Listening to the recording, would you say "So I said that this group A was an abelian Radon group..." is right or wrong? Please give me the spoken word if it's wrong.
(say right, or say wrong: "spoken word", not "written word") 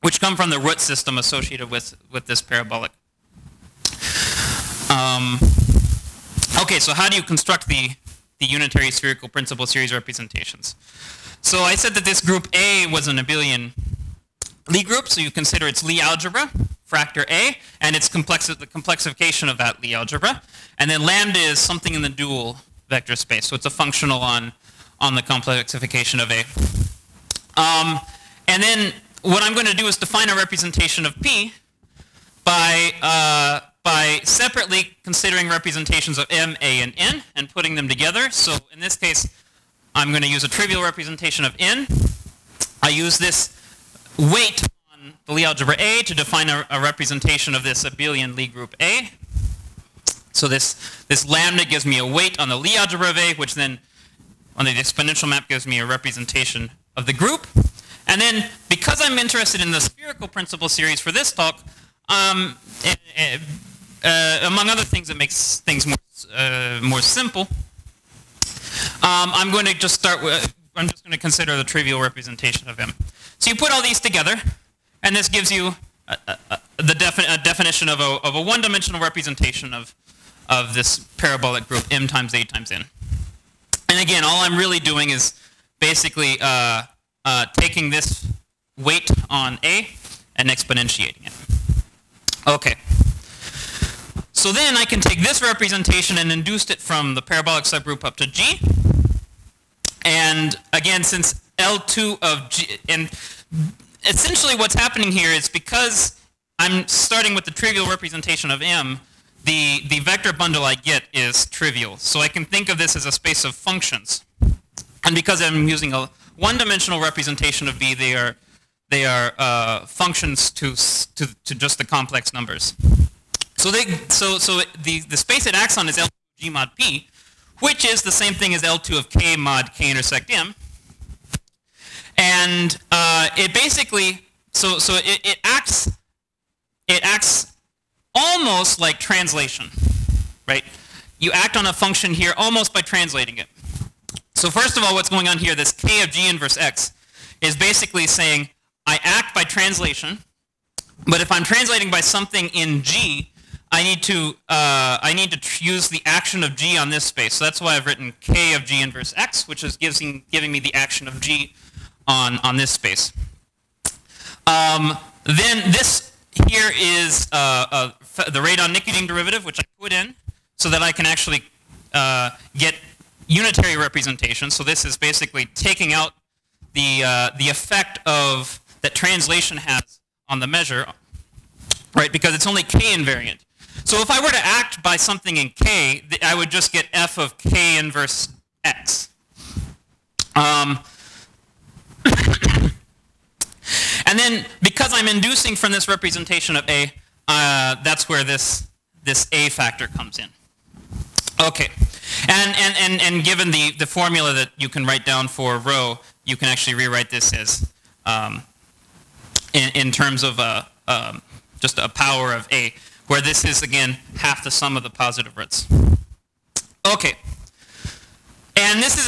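wrong: "Lie", not "Radon".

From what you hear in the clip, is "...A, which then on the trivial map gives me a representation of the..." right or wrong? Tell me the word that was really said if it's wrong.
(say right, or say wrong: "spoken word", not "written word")
wrong: "exponential", not "trivial".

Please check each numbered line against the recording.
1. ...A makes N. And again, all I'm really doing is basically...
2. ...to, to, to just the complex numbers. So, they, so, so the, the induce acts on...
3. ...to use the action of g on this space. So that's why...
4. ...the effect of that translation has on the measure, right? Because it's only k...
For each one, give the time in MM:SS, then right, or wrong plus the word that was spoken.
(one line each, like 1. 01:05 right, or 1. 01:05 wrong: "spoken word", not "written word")
1. 01:22 wrong: "times", not "makes"
2. 02:00 wrong: "space", not "induce"
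3. 02:35 right
4. 02:57 right.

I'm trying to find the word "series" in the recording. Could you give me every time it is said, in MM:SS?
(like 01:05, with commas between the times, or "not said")
00:09, 01:00.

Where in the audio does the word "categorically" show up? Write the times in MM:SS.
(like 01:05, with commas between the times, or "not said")
not said.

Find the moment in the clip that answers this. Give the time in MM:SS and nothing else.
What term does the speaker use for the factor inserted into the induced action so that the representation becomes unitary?
02:48.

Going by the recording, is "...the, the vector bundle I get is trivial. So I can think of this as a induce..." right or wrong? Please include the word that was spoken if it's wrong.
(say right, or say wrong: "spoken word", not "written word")
wrong: "space", not "induce".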